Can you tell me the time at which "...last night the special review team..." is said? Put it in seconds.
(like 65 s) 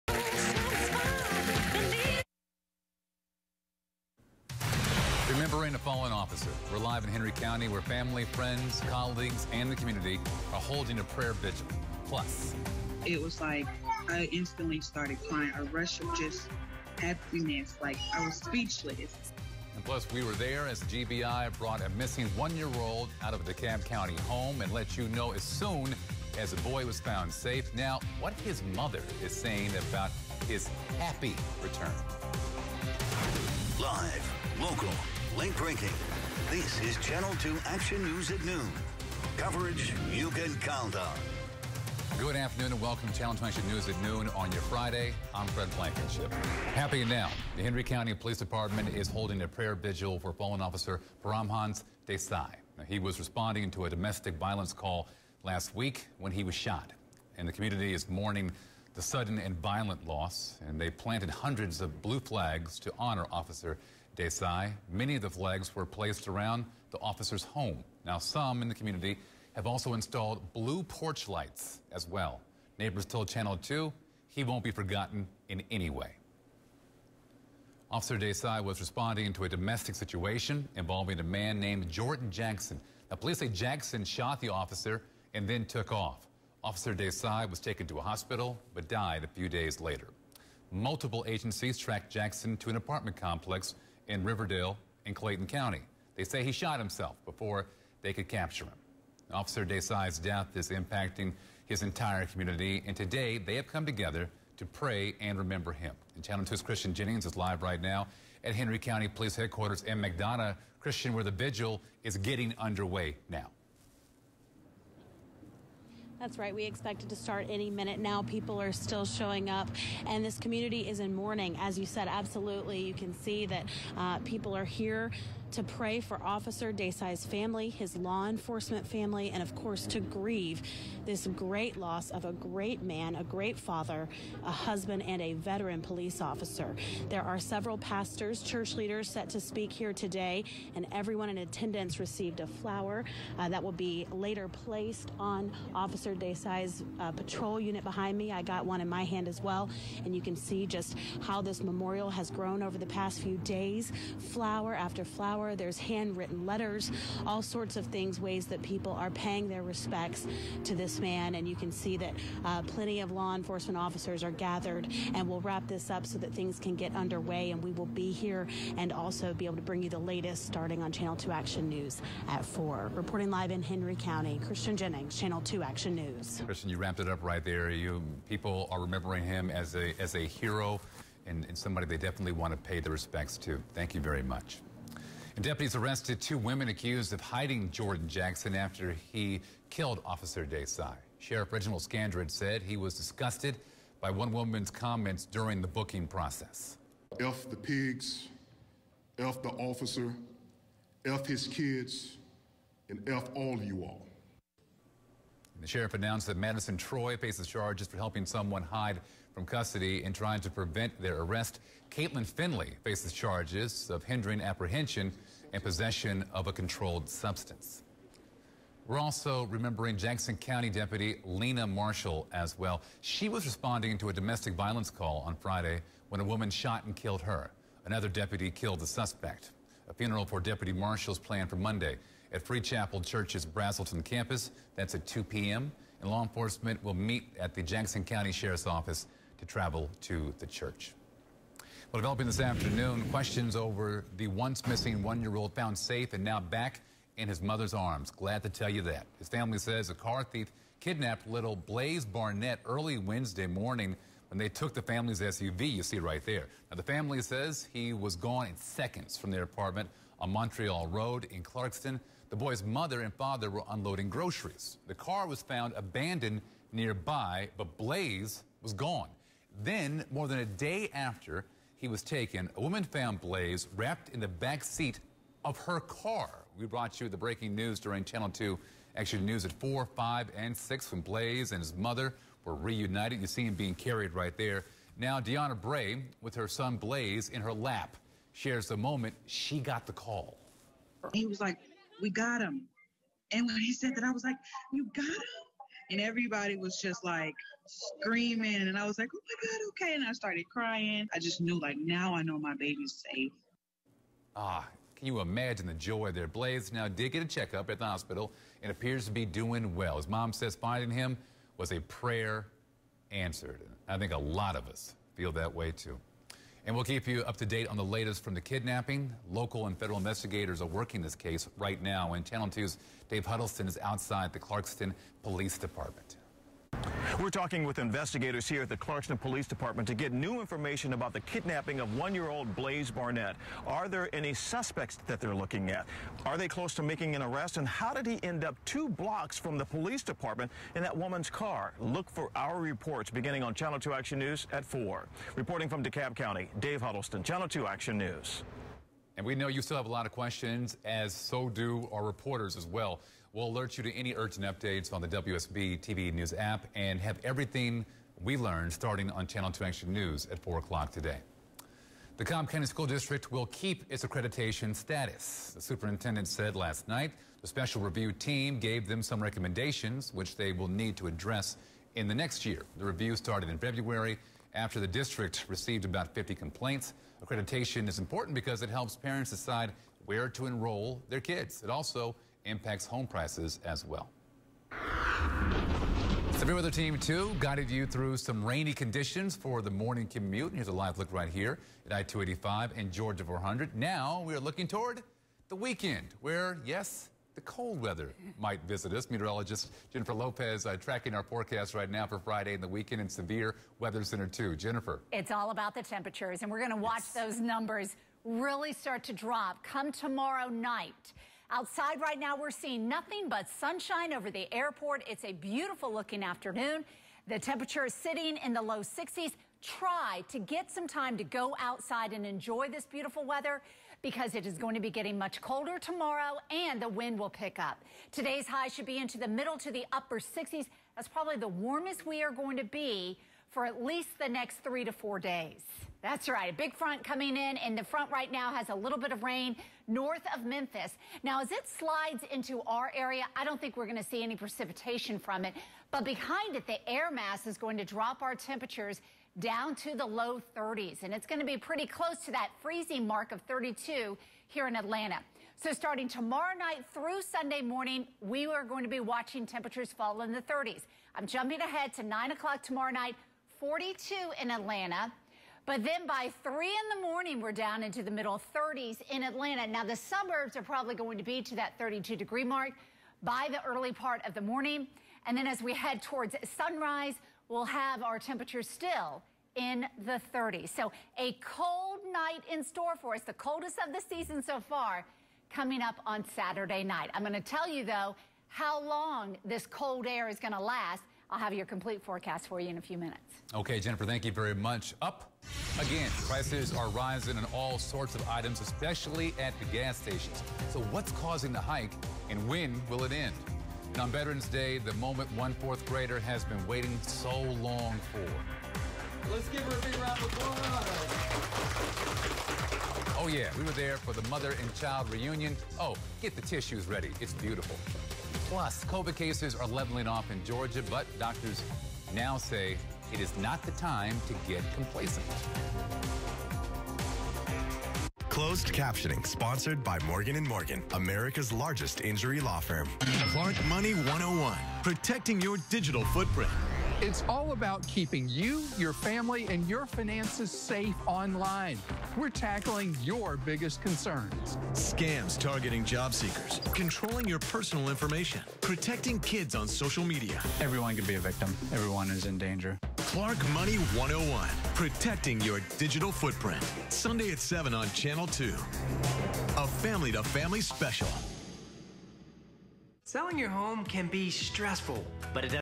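366 s.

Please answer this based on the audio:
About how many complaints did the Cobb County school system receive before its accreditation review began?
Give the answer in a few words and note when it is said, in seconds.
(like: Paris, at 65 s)
50, at 375 s.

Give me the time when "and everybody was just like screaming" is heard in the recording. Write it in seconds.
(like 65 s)
295 s.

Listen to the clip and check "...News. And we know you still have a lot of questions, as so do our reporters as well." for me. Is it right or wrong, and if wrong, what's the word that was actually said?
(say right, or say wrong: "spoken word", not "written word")
right.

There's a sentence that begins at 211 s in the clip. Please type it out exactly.
Caitlin Finley faces charges of hindering apprehension and possession of a controlled substance.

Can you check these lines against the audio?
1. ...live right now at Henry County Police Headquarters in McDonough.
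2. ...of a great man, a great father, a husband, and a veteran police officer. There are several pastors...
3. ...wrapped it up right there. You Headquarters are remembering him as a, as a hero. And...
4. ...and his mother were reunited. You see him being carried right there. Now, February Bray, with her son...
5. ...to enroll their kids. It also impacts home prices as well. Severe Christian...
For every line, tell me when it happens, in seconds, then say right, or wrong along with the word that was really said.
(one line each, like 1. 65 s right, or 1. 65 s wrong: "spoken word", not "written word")
1. 107 s right
2. 132 s right
3. 176 s wrong: "People", not "Headquarters"
4. 281 s wrong: "Deanna", not "February"
5. 380 s wrong: "Weather", not "Christian".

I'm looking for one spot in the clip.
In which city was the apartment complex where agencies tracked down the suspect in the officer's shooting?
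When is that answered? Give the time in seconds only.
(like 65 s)
94 s.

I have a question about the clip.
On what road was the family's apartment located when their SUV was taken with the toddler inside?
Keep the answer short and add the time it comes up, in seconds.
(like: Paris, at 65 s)
Montreal Road, at 260 s.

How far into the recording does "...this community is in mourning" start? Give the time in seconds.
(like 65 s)
120 s.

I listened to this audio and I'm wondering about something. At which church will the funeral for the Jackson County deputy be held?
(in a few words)
Free Chapel Church.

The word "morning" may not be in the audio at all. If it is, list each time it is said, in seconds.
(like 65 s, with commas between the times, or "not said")
253 s, 389 s, 457 s, 467 s, 474 s.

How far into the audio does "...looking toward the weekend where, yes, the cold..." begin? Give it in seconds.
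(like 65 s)
394 s.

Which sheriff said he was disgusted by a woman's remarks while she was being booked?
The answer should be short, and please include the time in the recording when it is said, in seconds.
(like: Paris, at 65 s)
Reginald Scandrett, at 191 s.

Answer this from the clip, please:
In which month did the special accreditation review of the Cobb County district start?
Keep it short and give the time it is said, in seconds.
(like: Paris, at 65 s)
February, at 373 s.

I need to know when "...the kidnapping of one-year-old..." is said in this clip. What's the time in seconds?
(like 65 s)
331 s.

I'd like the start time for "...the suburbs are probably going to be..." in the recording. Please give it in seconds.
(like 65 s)
469 s.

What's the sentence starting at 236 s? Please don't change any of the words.
And law enforcement will meet at the Jackson County Sheriff's Office to travel to the church.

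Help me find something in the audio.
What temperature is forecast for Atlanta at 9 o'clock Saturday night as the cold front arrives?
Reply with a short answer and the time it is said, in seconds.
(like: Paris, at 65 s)
42, at 463 s.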